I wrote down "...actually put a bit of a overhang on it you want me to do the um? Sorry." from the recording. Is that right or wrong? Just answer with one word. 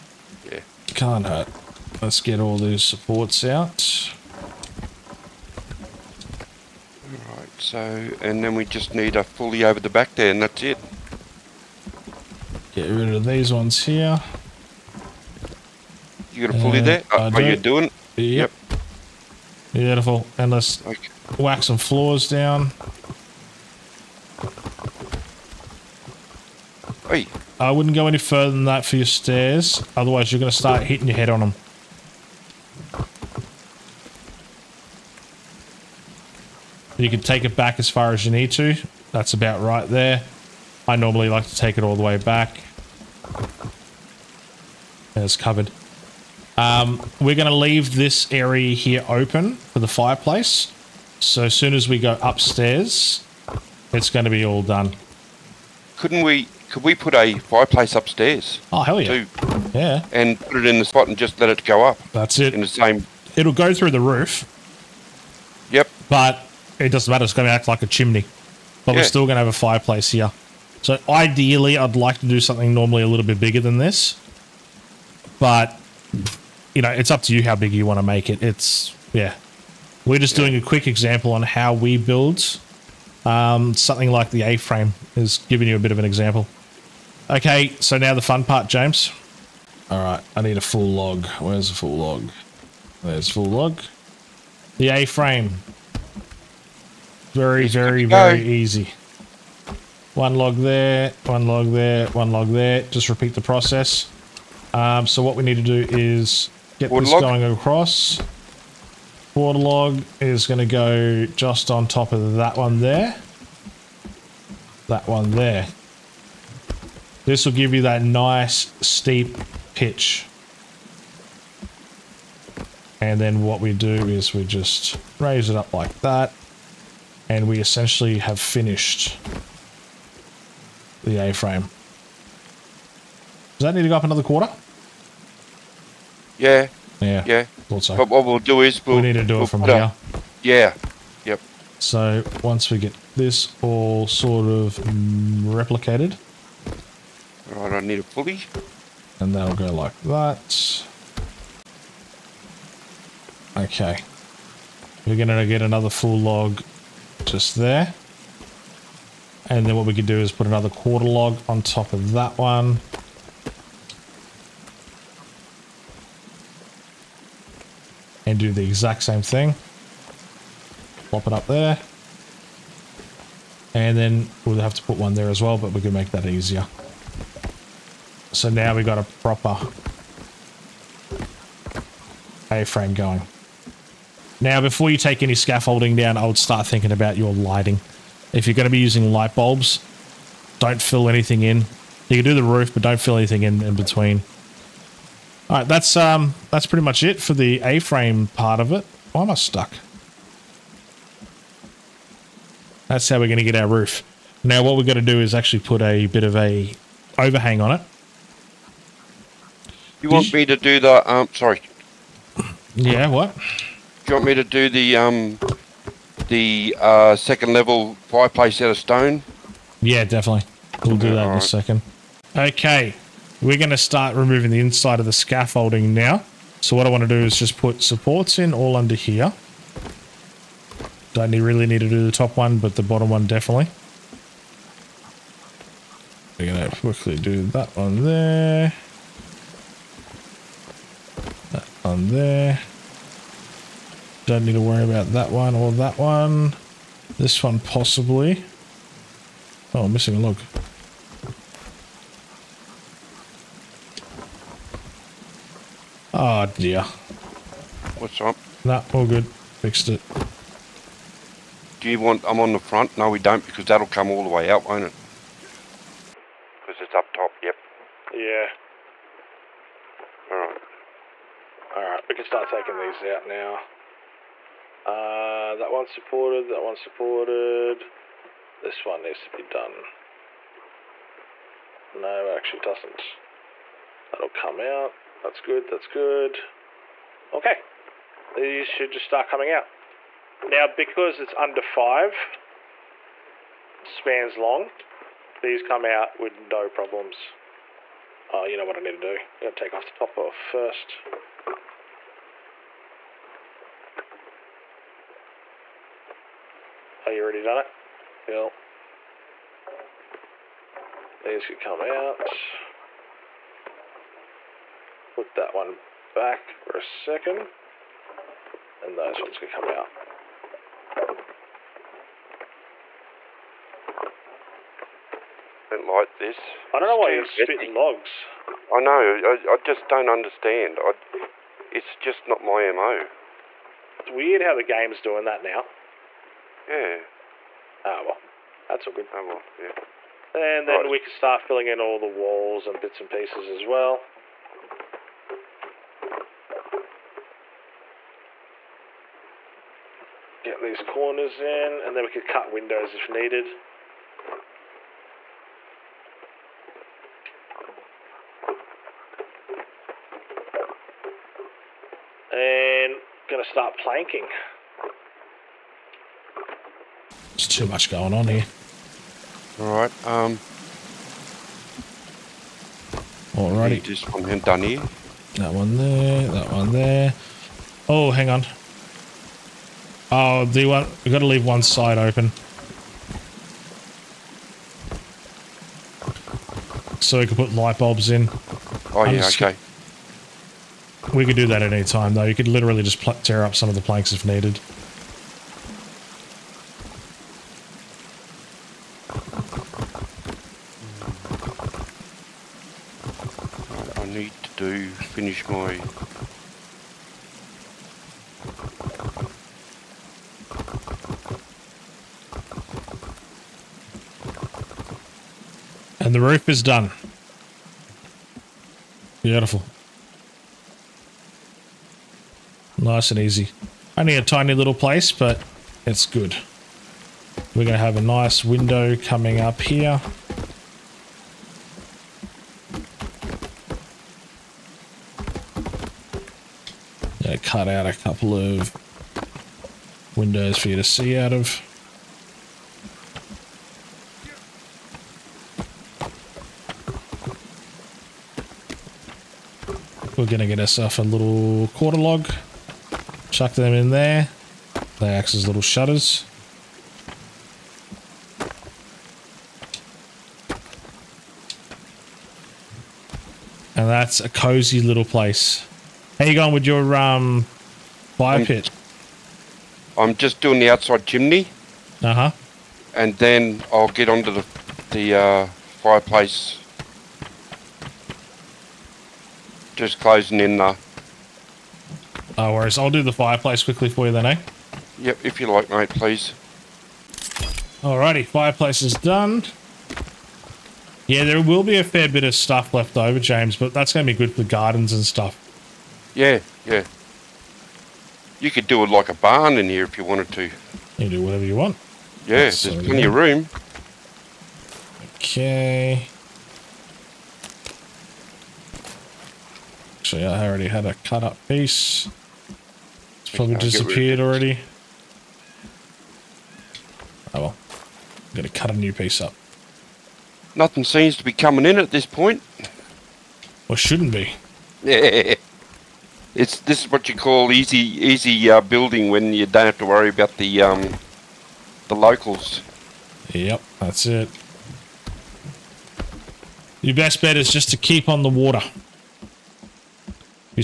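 right.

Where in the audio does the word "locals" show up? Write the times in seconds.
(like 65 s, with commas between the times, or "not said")
531 s.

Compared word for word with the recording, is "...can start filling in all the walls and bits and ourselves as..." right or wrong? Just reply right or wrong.
wrong.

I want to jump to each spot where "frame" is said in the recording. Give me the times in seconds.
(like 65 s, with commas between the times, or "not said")
84 s, 94 s, 131 s, 182 s, 197 s.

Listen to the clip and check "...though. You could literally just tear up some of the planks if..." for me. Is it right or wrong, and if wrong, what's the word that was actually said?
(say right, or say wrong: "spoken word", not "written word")
right.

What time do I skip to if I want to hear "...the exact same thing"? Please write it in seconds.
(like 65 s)
168 s.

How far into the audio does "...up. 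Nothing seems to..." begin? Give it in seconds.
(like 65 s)
519 s.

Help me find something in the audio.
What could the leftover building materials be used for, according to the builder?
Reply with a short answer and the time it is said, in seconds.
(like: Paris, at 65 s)
Gardens, at 494 s.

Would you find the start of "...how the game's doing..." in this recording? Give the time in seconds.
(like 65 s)
334 s.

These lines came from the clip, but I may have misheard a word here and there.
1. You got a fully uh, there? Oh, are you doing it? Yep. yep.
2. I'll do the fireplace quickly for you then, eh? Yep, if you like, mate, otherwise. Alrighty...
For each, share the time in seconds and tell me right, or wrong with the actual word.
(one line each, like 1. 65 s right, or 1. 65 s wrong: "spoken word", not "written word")
1. 16 s right
2. 482 s wrong: "please", not "otherwise".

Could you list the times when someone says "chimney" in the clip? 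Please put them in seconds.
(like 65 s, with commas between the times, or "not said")
67 s, 471 s.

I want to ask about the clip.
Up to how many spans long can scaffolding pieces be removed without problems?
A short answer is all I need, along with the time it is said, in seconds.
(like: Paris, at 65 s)
5 spans, at 291 s.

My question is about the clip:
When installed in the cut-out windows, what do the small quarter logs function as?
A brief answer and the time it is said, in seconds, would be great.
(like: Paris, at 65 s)
Shutters, at 455 s.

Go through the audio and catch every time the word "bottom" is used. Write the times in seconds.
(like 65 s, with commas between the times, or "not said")
232 s.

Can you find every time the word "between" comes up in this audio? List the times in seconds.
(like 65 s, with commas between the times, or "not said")
193 s.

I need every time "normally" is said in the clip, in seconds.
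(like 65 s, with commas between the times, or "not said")
40 s, 72 s.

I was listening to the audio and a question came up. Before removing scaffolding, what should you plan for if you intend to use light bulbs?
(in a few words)
Lighting.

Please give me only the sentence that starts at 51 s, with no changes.
So as soon as we go upstairs, it's going to be all done.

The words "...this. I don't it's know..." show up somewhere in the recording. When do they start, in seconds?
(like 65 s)
326 s.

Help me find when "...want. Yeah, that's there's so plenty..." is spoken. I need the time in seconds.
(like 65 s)
501 s.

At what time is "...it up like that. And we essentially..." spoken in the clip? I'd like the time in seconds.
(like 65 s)
125 s.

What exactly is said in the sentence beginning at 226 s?
So what I want to do is just put supports in all under here.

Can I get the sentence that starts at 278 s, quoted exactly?
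This one needs to be done.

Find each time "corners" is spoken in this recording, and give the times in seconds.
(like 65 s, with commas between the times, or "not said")
350 s.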